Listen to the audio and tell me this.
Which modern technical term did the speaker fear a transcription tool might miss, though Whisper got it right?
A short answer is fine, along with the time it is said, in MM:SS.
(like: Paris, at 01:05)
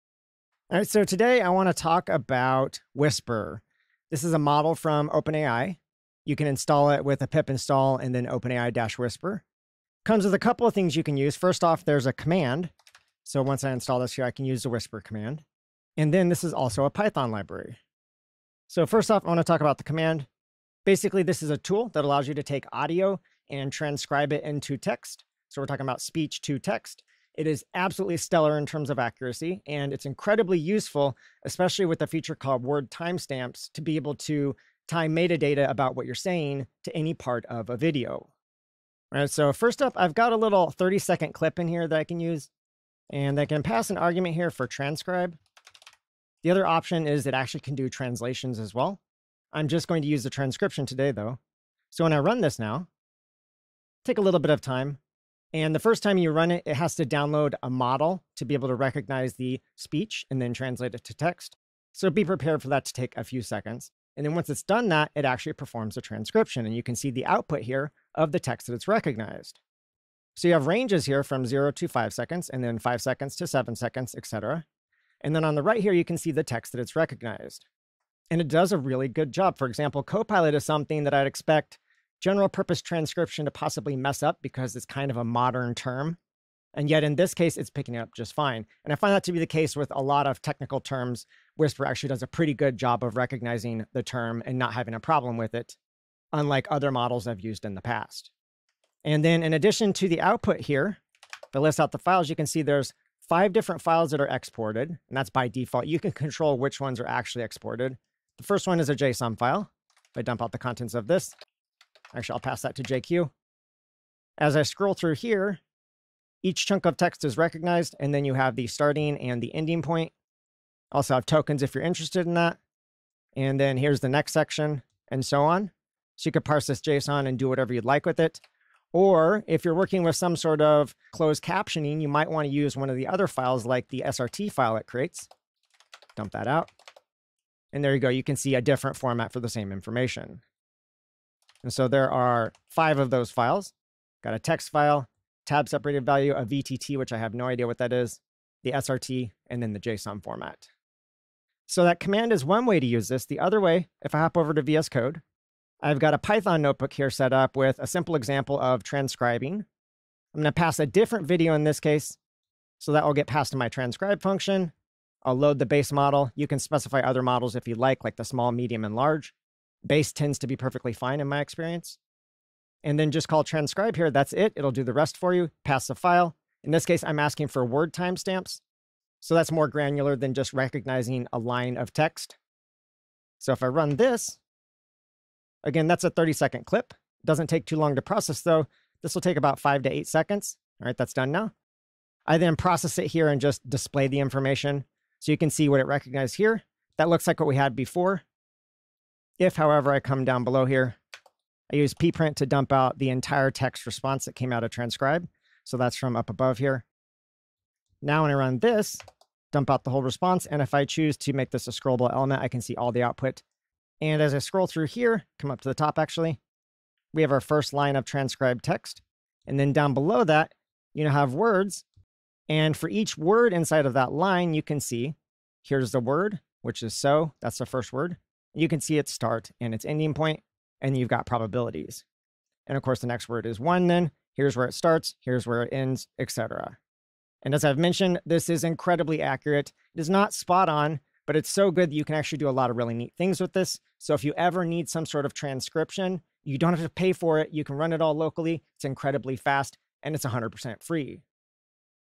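Copilot, at 01:20.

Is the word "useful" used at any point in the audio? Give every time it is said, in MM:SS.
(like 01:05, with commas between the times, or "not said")
00:30.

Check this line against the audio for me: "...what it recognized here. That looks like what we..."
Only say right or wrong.
right.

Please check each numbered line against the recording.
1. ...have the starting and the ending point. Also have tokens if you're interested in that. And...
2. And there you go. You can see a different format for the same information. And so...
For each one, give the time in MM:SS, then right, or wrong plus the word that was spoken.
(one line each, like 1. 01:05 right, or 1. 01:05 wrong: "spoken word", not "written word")
1. 01:58 right
2. 02:17 right.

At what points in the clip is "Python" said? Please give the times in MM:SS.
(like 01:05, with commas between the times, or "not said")
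00:16, 02:36.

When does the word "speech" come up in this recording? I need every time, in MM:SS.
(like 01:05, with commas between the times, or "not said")
00:25, 00:59.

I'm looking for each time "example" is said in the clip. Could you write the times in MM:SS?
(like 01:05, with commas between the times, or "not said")
01:19, 02:38.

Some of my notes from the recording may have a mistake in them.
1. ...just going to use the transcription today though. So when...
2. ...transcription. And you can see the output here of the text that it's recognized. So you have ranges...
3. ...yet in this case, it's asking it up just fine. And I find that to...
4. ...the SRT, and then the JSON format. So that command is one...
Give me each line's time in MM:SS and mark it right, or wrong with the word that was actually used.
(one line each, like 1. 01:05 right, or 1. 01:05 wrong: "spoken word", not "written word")
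1. 00:49 right
2. 01:06 right
3. 01:26 wrong: "picking", not "asking"
4. 02:28 right.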